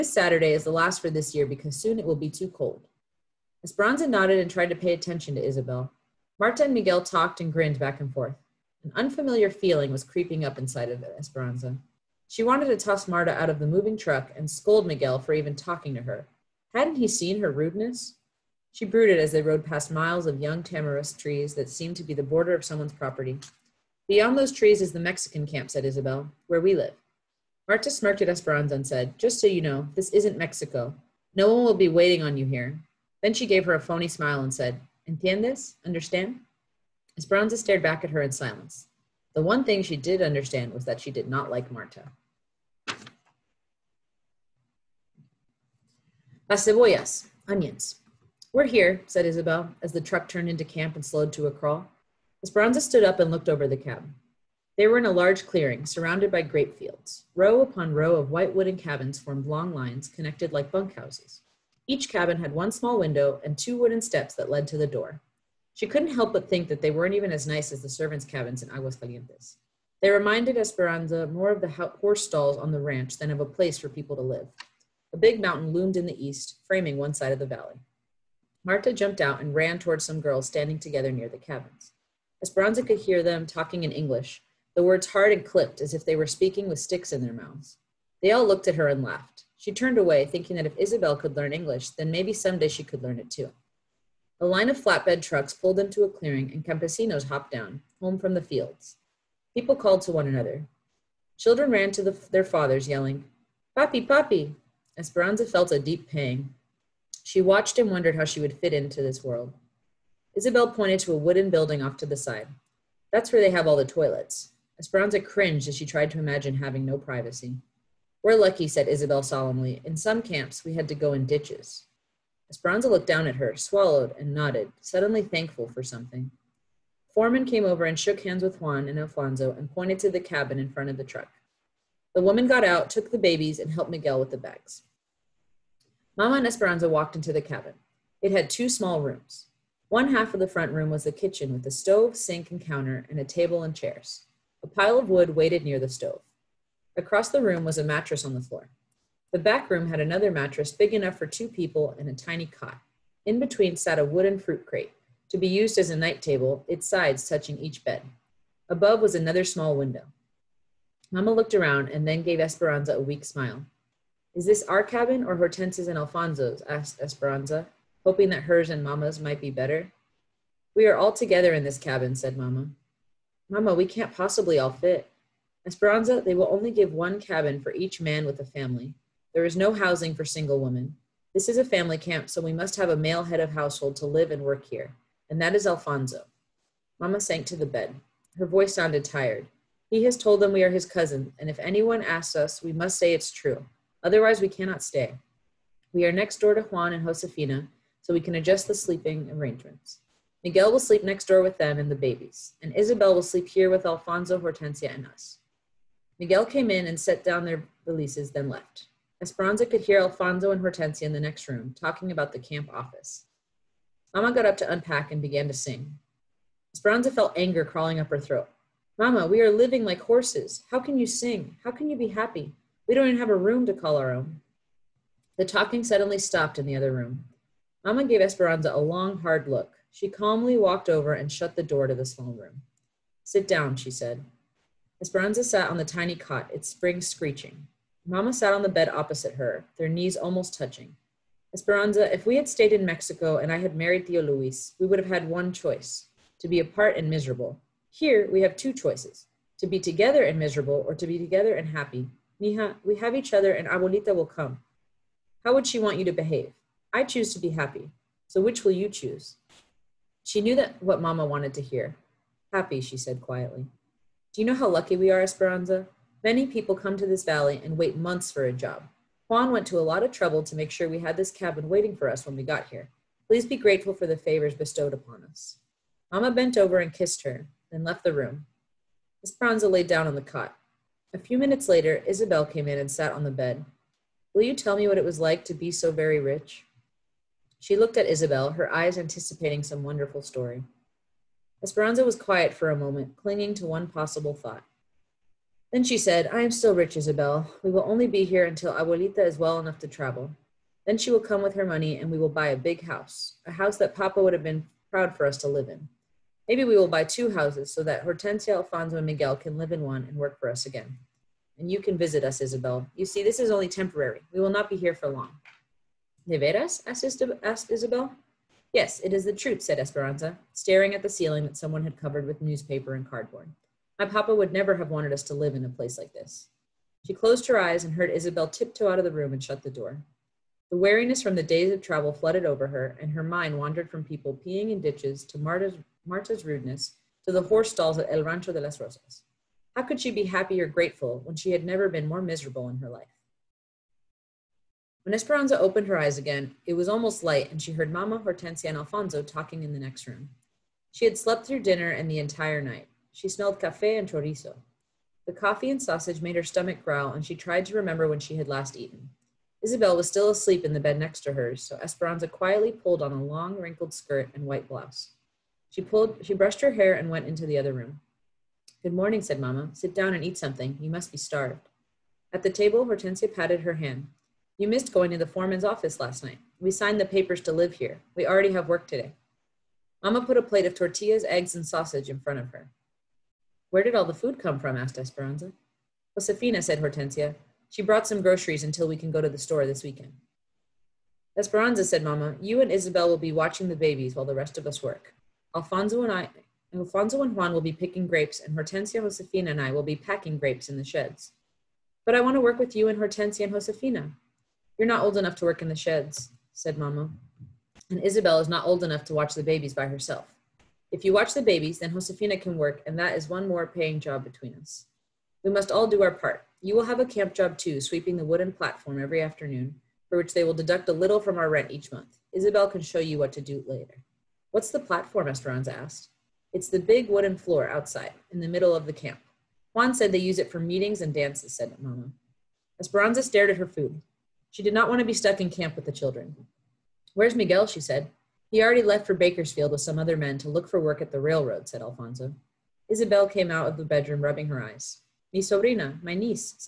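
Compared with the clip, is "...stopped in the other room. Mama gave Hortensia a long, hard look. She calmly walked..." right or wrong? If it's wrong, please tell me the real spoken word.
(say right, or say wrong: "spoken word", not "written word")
wrong: "Esperanza", not "Hortensia".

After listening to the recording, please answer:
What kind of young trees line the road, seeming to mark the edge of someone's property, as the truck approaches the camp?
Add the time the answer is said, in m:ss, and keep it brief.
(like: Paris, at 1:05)
tamarisk, at 0:20.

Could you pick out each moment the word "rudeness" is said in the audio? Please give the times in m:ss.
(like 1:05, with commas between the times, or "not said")
0:17, 5:36.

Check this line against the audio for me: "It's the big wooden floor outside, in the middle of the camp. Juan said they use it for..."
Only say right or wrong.
right.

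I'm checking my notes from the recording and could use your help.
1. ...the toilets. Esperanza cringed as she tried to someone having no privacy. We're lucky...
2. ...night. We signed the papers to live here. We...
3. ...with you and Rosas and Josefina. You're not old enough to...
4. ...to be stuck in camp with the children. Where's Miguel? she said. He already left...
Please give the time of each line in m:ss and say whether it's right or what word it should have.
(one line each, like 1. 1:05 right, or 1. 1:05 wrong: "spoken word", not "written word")
1. 1:53 wrong: "imagine", not "someone"
2. 6:16 right
3. 6:42 wrong: "Hortensia", not "Rosas"
4. 7:14 right.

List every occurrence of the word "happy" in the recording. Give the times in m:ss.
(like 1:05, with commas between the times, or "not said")
3:42, 4:11, 4:17, 4:22, 5:40.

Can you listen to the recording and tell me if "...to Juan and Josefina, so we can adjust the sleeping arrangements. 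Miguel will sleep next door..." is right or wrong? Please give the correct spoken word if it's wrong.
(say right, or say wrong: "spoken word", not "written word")
right.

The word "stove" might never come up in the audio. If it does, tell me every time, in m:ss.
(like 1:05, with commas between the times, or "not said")
2:21, 2:25.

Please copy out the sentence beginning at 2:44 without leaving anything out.
Is this our cabin or Hortensia's and Alfonso's?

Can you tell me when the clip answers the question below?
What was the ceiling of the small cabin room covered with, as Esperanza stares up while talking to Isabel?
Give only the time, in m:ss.
5:22.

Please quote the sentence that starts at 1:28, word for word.
They all looked at her and laughed.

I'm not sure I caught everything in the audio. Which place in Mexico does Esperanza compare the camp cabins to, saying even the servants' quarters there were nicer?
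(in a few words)
Aguascalientes.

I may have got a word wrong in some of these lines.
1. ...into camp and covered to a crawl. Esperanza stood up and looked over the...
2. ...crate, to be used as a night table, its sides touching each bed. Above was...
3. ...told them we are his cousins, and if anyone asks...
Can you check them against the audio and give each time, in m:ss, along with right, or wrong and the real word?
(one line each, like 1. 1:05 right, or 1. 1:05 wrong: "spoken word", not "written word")
1. 0:50 wrong: "slowed", not "covered"
2. 2:34 right
3. 3:10 right.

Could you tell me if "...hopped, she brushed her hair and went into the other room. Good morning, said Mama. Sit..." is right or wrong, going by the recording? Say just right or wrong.
wrong.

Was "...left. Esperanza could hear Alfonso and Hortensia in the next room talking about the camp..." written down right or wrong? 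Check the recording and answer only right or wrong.
right.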